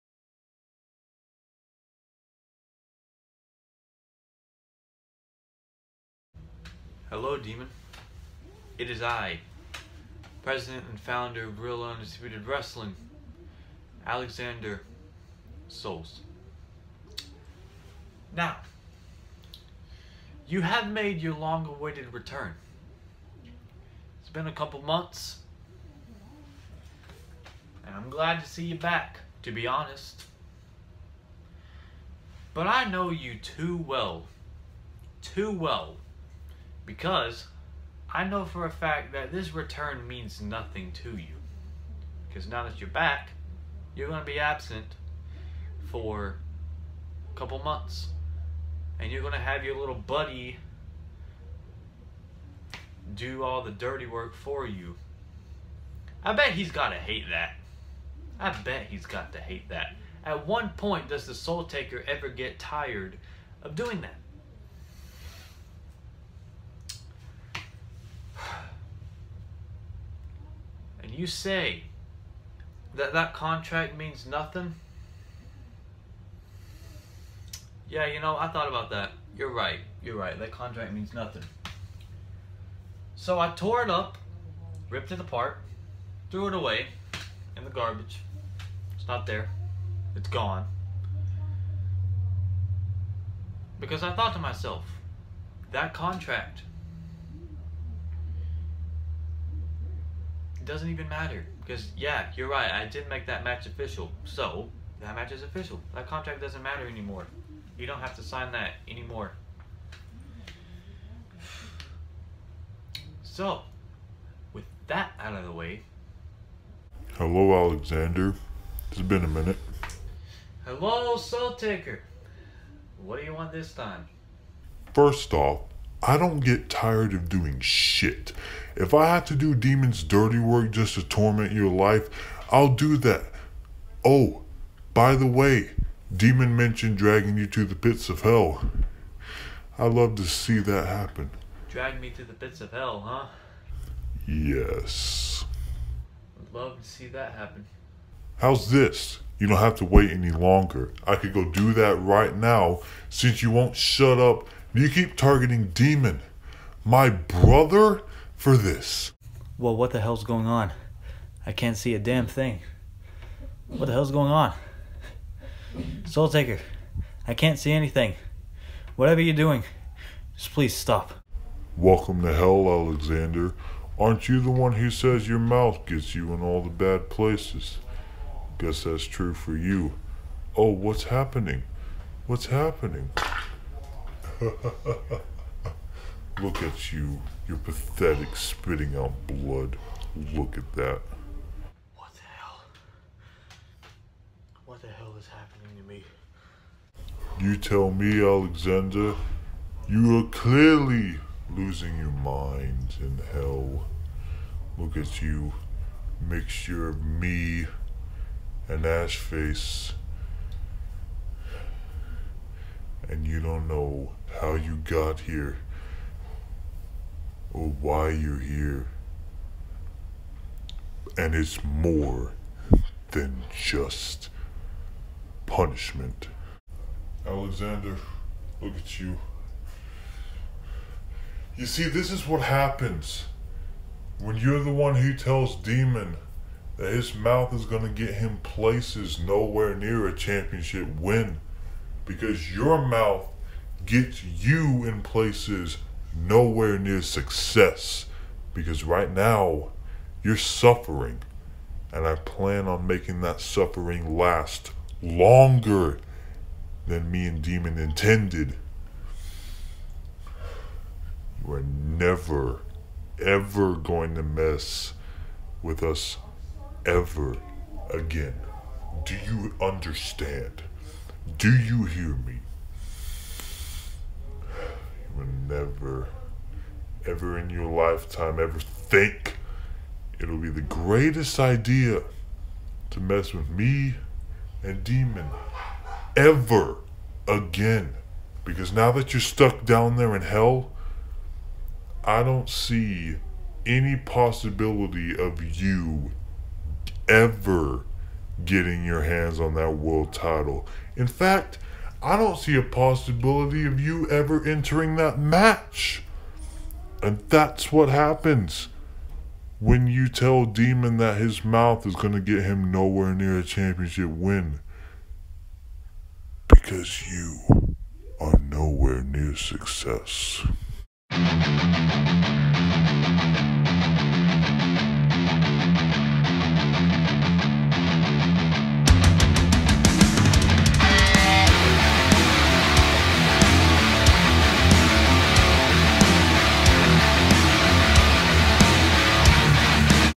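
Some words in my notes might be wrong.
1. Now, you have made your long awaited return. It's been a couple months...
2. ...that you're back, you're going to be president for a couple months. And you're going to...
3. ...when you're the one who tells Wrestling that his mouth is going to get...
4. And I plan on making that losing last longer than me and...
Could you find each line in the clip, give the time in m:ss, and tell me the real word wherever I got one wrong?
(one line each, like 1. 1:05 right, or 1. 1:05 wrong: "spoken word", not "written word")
1. 0:18 right
2. 0:42 wrong: "absent", not "president"
3. 3:54 wrong: "Demon", not "Wrestling"
4. 4:11 wrong: "suffering", not "losing".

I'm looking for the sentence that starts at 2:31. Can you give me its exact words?
I could go do that right now since you won't shut up you keep targeting Demon, my brother, for this.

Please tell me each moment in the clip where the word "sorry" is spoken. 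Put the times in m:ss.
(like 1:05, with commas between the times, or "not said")
not said.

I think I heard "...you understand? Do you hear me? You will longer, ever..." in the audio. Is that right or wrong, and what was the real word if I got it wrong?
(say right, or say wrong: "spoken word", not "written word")
wrong: "never", not "longer".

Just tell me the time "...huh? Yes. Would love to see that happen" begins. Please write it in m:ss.
2:23.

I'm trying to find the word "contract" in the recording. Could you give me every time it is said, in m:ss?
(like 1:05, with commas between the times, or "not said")
1:13, 1:20, 1:35, 1:46.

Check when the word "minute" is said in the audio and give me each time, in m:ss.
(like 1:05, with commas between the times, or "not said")
1:59.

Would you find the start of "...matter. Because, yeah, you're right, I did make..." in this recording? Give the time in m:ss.
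1:41.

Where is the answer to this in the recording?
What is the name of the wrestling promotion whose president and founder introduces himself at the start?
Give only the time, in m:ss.
0:11.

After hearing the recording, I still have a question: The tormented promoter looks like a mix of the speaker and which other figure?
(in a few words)
Ashface.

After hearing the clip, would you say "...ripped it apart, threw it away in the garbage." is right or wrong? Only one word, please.
right.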